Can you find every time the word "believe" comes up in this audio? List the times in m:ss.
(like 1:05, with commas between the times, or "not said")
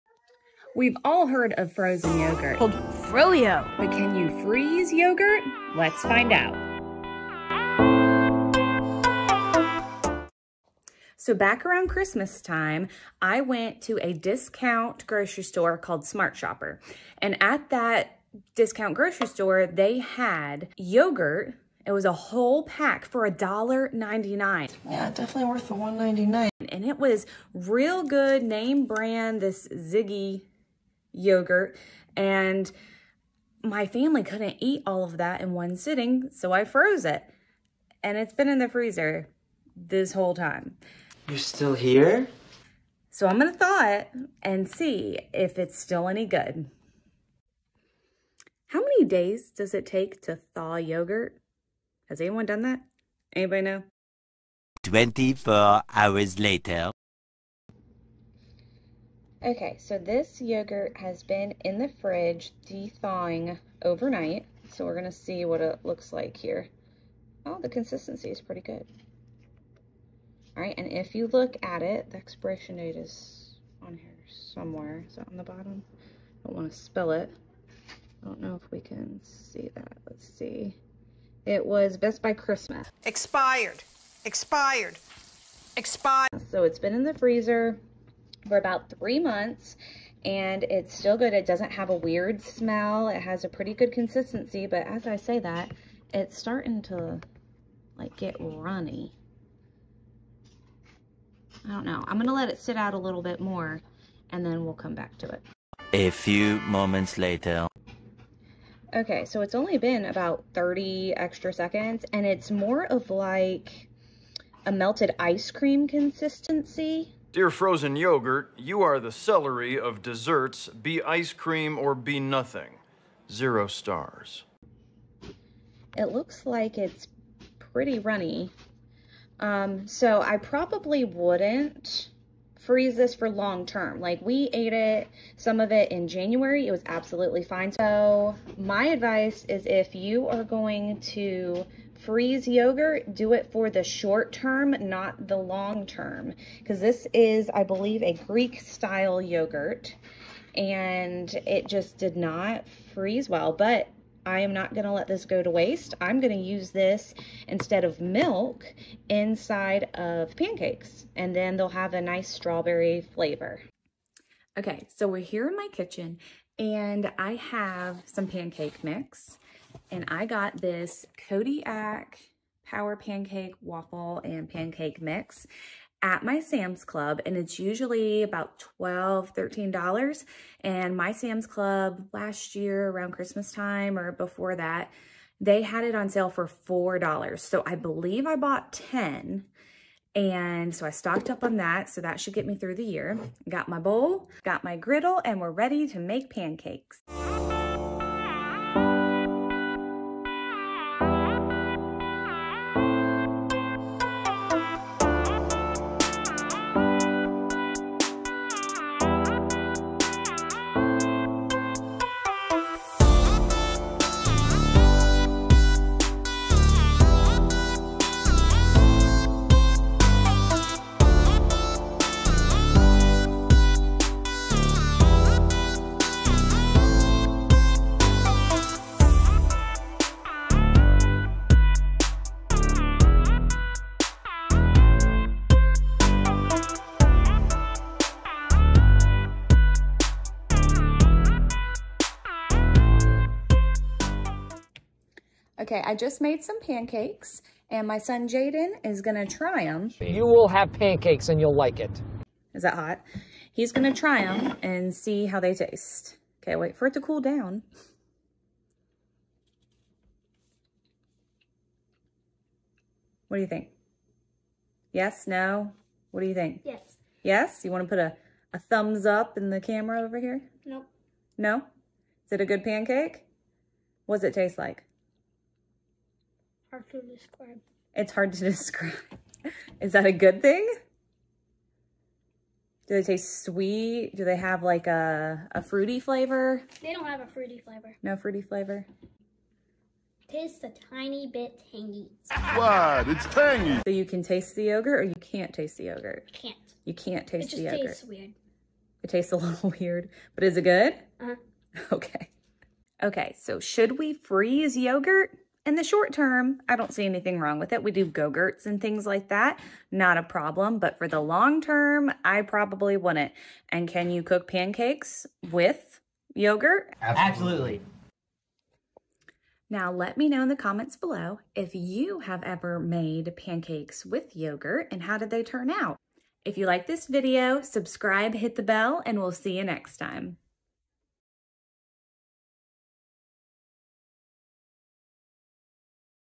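2:27, 3:07.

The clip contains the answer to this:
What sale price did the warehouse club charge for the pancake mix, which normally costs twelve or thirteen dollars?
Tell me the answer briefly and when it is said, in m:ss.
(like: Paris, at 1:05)
$4, at 3:06.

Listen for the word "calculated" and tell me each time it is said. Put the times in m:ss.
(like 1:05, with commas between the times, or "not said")
not said.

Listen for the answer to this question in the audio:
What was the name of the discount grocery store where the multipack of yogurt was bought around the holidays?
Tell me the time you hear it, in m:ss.
0:16.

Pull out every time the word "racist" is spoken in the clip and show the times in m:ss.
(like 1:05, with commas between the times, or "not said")
not said.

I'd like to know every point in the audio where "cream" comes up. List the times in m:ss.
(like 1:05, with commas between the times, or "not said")
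1:55, 2:01.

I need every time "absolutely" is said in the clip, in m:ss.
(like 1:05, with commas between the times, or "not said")
2:16, 5:17.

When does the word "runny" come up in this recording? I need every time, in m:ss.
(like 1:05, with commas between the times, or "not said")
1:38, 2:07.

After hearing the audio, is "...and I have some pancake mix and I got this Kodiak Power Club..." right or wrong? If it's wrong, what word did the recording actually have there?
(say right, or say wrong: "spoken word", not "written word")
wrong: "Pancake", not "Club".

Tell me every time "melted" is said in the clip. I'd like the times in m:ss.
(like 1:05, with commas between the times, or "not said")
1:54.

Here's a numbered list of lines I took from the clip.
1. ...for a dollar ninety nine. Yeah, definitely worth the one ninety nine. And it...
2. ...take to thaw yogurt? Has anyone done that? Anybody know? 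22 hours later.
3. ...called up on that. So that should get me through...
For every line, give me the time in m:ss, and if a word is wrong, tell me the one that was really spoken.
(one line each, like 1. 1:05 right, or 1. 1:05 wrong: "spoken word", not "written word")
1. 0:23 right
2. 0:49 wrong: "24", not "22"
3. 3:10 wrong: "stocked", not "called".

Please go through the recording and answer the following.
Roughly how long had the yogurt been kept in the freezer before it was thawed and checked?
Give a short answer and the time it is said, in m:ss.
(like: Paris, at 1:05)
3 months, at 1:28.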